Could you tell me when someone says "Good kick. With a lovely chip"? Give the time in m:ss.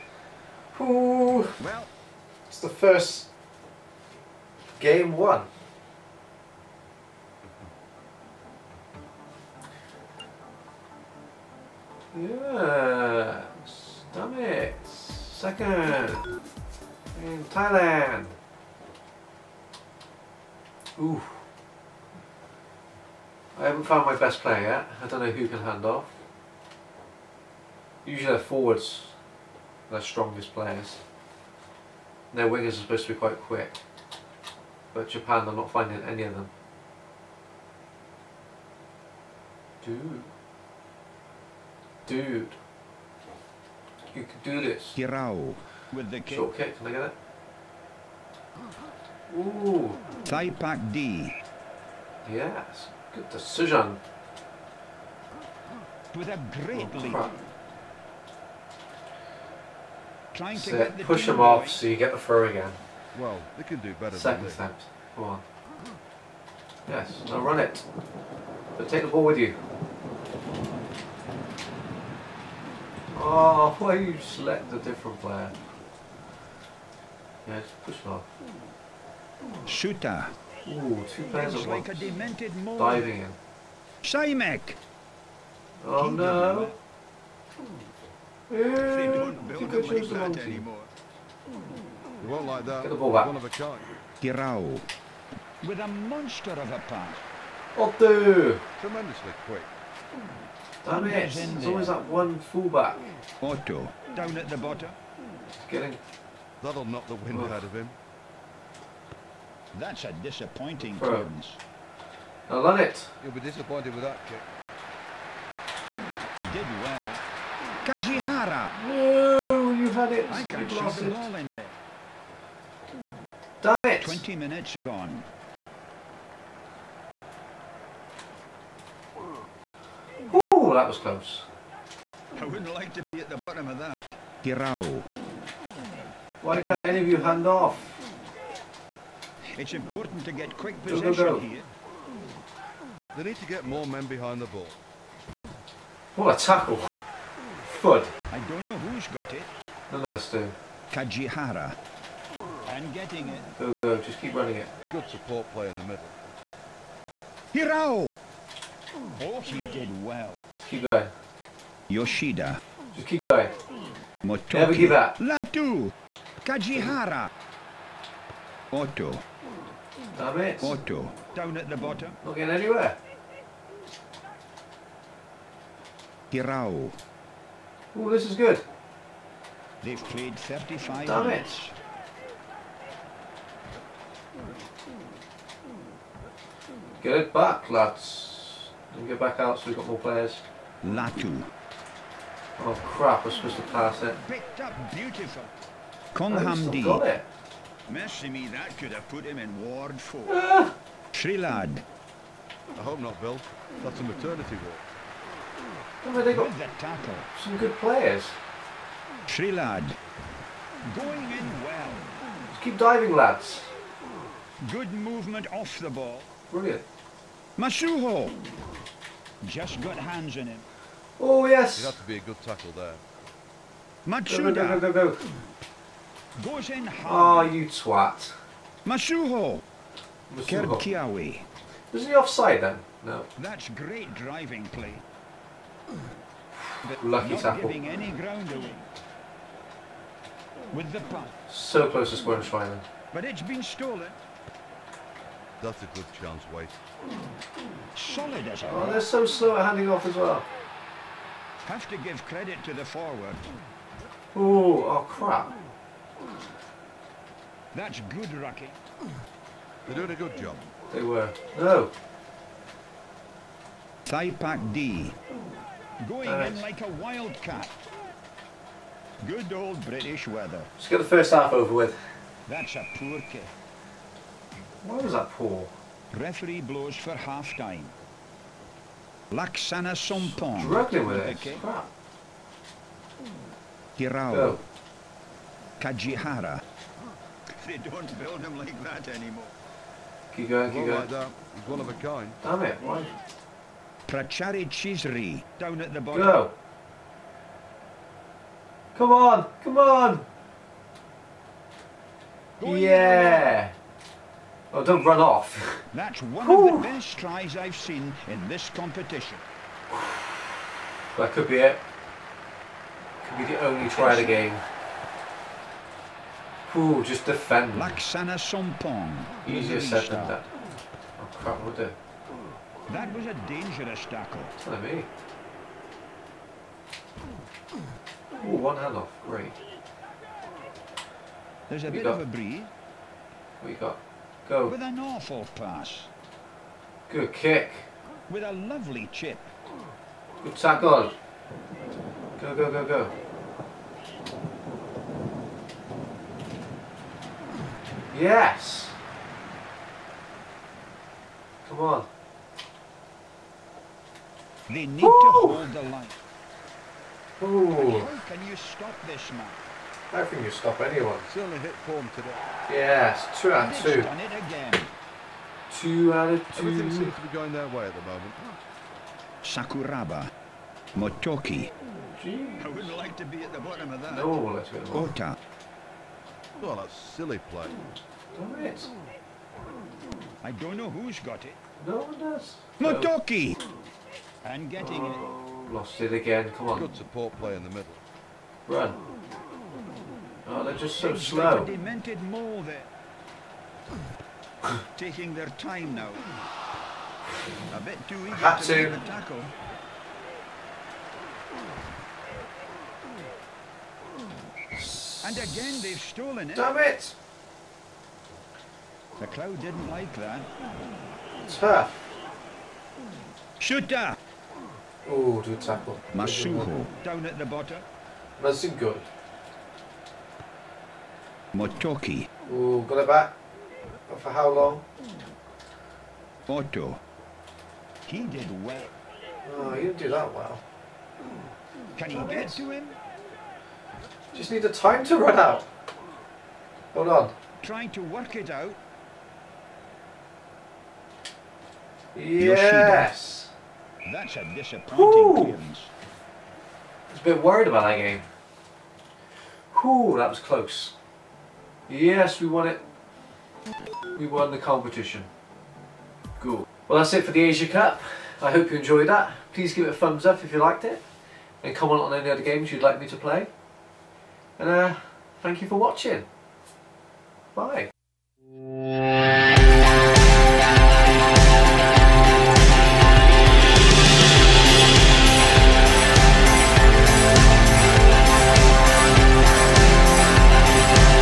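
5:37.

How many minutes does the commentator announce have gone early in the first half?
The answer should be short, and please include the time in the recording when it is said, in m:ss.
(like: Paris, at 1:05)
20, at 2:04.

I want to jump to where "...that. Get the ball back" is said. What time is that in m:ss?
1:32.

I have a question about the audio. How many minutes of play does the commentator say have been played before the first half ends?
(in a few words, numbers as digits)
35.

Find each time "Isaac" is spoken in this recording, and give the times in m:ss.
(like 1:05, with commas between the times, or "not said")
not said.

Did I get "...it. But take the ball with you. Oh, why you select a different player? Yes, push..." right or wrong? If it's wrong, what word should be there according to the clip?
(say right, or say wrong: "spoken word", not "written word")
right.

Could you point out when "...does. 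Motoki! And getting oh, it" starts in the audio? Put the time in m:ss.
6:22.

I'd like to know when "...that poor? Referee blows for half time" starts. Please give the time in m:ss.
4:35.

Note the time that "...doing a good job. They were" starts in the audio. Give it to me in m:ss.
4:19.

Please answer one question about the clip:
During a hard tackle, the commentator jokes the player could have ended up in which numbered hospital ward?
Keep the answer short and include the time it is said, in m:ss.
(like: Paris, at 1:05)
Ward 4, at 3:19.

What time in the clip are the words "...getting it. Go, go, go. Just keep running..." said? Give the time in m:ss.
2:32.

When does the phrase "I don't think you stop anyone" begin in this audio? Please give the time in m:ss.
6:00.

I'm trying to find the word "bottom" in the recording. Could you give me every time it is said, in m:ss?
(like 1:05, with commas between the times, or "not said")
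1:44, 2:13, 2:51, 4:56, 6:13, 6:57.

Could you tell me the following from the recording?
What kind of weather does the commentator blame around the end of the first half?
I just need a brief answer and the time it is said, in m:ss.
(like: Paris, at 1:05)
British weather, at 4:29.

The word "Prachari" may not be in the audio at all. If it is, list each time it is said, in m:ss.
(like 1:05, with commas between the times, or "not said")
4:54.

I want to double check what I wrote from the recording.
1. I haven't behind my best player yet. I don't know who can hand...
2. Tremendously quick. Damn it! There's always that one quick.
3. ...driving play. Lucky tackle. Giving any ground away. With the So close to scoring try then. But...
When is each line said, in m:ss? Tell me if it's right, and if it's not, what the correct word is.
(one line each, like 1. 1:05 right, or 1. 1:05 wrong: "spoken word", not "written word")
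1. 0:23 wrong: "found", not "behind"
2. 1:38 wrong: "fullback", not "quick"
3. 3:54 right.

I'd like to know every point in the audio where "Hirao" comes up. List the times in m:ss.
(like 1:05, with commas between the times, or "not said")
2:37, 2:56, 4:43.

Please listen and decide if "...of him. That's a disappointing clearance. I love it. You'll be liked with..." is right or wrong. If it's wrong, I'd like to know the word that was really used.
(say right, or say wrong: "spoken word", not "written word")
wrong: "disappointed", not "liked".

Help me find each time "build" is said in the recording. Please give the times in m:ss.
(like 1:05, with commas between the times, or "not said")
1:29, 4:48.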